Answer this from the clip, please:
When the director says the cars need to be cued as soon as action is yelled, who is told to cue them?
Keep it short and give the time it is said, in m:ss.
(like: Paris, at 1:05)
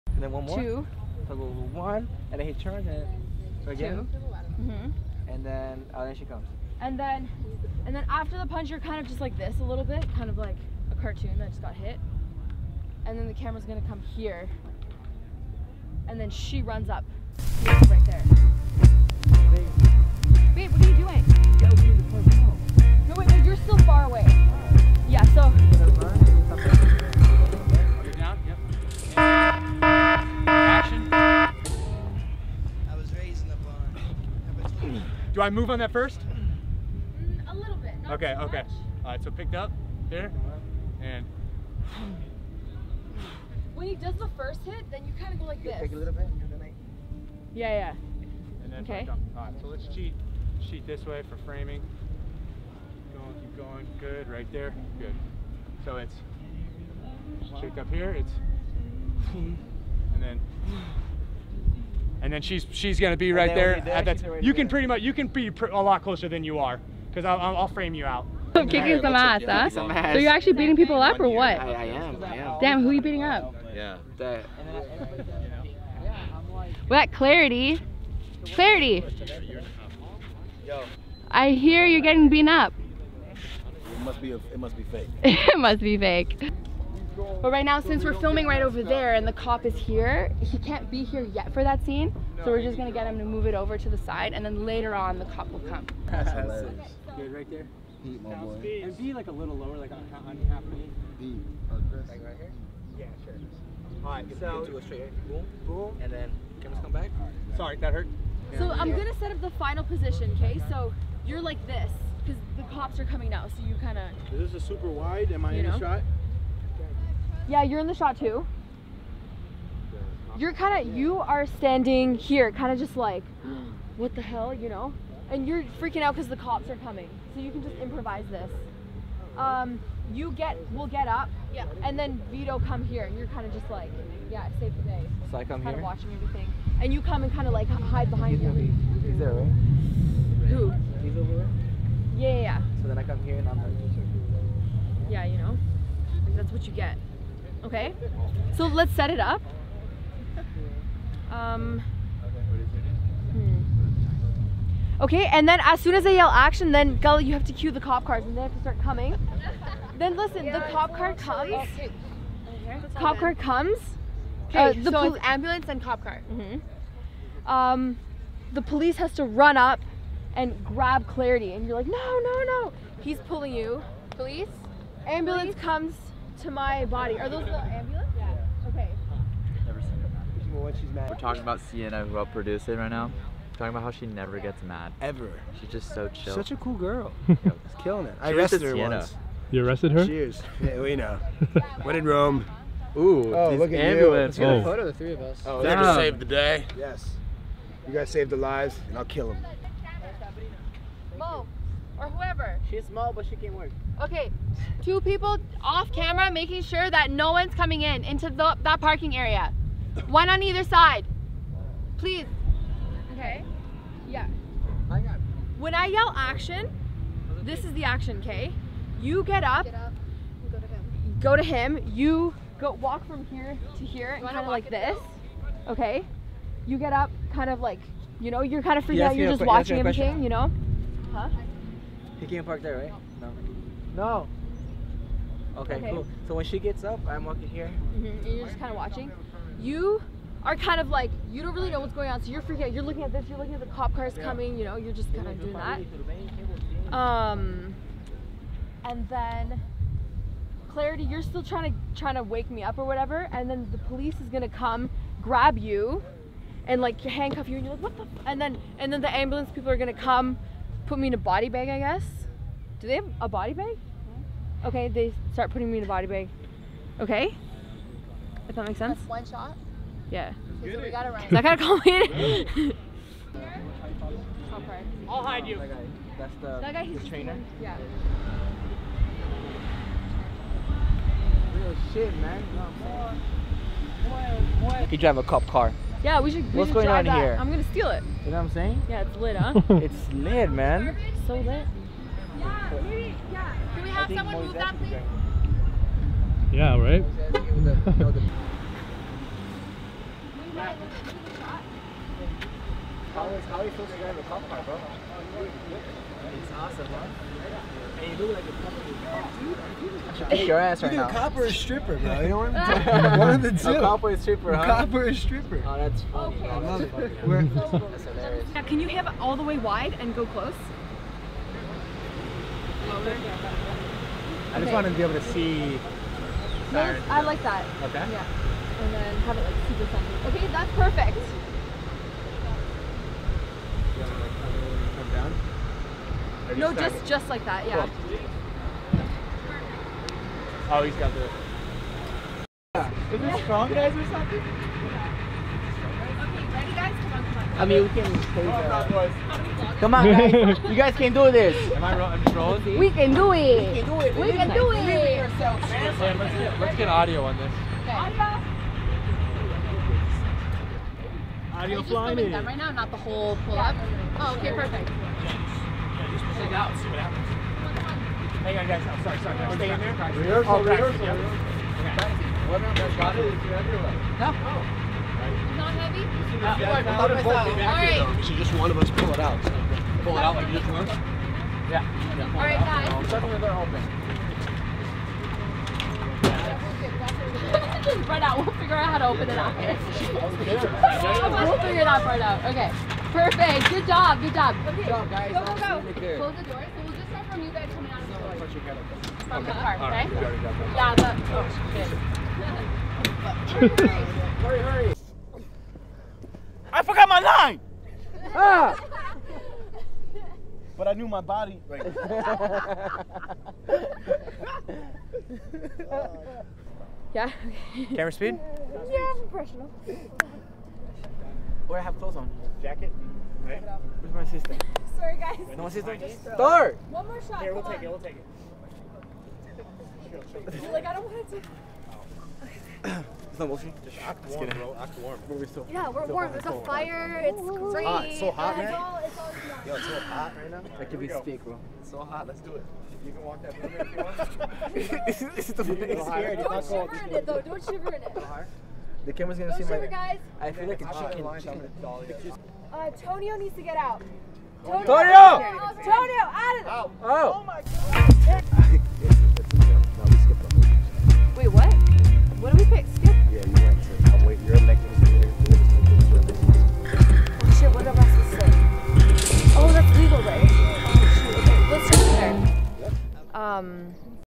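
Gully, at 2:36.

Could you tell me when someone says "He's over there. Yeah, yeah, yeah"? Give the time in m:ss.
2:21.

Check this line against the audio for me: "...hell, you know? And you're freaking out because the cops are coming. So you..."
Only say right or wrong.
right.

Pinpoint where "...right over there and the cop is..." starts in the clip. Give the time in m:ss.
1:28.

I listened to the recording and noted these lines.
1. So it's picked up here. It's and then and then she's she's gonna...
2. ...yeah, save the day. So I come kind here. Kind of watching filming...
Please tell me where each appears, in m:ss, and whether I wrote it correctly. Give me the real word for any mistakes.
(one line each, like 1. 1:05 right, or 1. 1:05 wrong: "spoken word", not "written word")
1. 0:55 wrong: "shaped", not "picked"
2. 2:14 wrong: "everything", not "filming".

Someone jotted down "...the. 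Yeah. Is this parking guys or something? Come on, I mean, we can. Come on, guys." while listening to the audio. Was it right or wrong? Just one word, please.
wrong.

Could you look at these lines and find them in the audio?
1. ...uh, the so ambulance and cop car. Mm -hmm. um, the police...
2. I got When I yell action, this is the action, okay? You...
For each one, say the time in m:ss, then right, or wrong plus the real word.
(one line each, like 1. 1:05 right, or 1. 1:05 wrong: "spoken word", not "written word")
1. 2:44 right
2. 3:34 right.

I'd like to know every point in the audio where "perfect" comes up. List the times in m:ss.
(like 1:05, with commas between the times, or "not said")
5:30, 6:04, 6:33.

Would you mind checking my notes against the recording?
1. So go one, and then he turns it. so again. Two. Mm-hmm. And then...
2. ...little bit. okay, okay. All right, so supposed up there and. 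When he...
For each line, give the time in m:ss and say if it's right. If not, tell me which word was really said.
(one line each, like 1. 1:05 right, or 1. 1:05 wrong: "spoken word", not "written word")
1. 0:01 right
2. 0:37 wrong: "picked", not "supposed".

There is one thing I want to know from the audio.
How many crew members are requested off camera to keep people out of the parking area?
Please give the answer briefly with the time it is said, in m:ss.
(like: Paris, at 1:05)
2, at 3:24.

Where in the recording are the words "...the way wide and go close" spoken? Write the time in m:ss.
5:19.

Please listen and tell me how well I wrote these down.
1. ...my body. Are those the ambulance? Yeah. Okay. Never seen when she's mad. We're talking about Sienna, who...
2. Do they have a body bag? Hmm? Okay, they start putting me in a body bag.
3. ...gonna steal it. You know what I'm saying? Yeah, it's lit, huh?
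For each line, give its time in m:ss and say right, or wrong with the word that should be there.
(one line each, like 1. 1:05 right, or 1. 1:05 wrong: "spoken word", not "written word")
1. 2:56 right
2. 4:22 right
3. 4:47 right.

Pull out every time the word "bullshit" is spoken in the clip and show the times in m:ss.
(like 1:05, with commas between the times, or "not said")
7:13.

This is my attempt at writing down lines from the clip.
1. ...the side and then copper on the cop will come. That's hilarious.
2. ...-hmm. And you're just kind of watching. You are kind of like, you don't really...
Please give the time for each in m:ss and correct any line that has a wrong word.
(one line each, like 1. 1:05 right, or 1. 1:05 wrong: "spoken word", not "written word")
1. 1:33 wrong: "later", not "copper"
2. 3:57 right.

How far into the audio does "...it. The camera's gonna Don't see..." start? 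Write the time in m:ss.
7:28.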